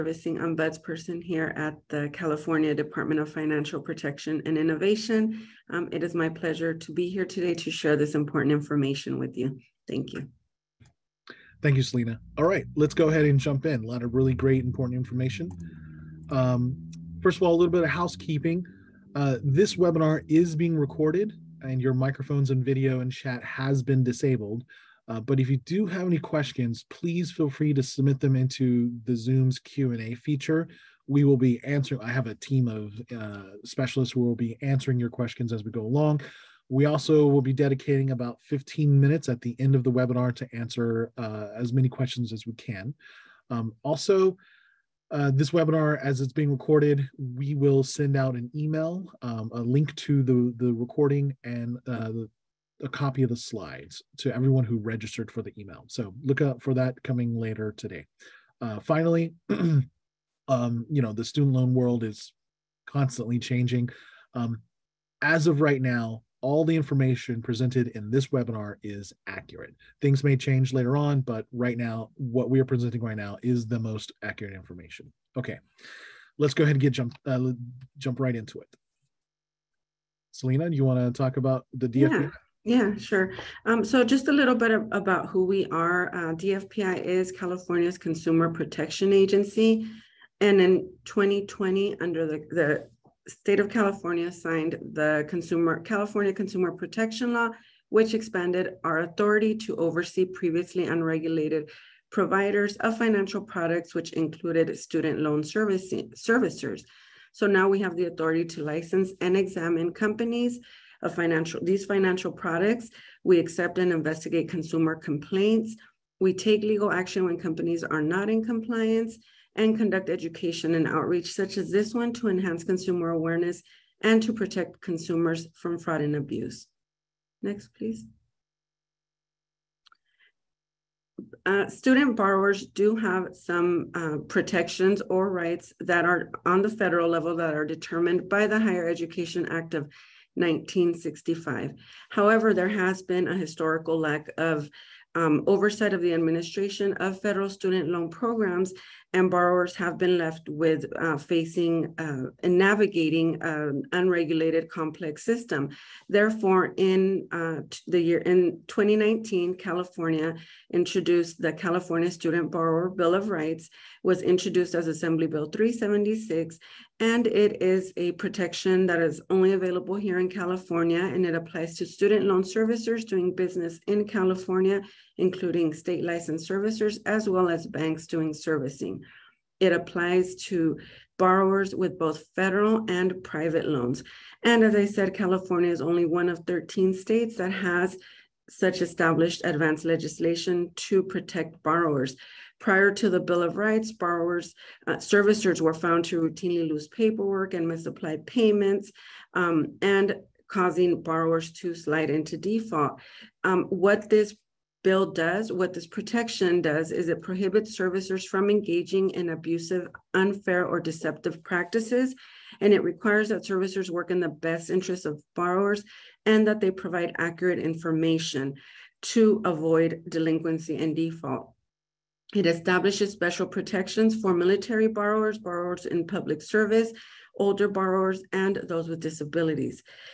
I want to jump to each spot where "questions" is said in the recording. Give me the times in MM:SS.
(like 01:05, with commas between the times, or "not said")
00:26, 00:35, 00:41.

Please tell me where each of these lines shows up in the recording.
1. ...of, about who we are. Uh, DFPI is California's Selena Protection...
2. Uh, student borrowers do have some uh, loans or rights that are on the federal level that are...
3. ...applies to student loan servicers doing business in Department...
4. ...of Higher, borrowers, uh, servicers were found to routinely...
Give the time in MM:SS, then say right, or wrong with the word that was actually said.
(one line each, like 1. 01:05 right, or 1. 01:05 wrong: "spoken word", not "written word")
1. 01:24 wrong: "Consumer", not "Selena"
2. 02:11 wrong: "protections", not "loans"
3. 02:51 wrong: "California", not "Department"
4. 03:13 wrong: "Rights", not "Higher".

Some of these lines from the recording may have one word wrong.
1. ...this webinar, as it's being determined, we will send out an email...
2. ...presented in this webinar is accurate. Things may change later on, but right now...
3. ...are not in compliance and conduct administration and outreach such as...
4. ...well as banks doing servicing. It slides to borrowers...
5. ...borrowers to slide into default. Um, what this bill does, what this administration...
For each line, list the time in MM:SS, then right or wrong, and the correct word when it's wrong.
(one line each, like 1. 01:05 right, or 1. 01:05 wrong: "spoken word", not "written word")
1. 00:45 wrong: "recorded", not "determined"
2. 01:07 right
3. 01:57 wrong: "education", not "administration"
4. 02:57 wrong: "applies", not "slides"
5. 03:21 wrong: "protection", not "administration".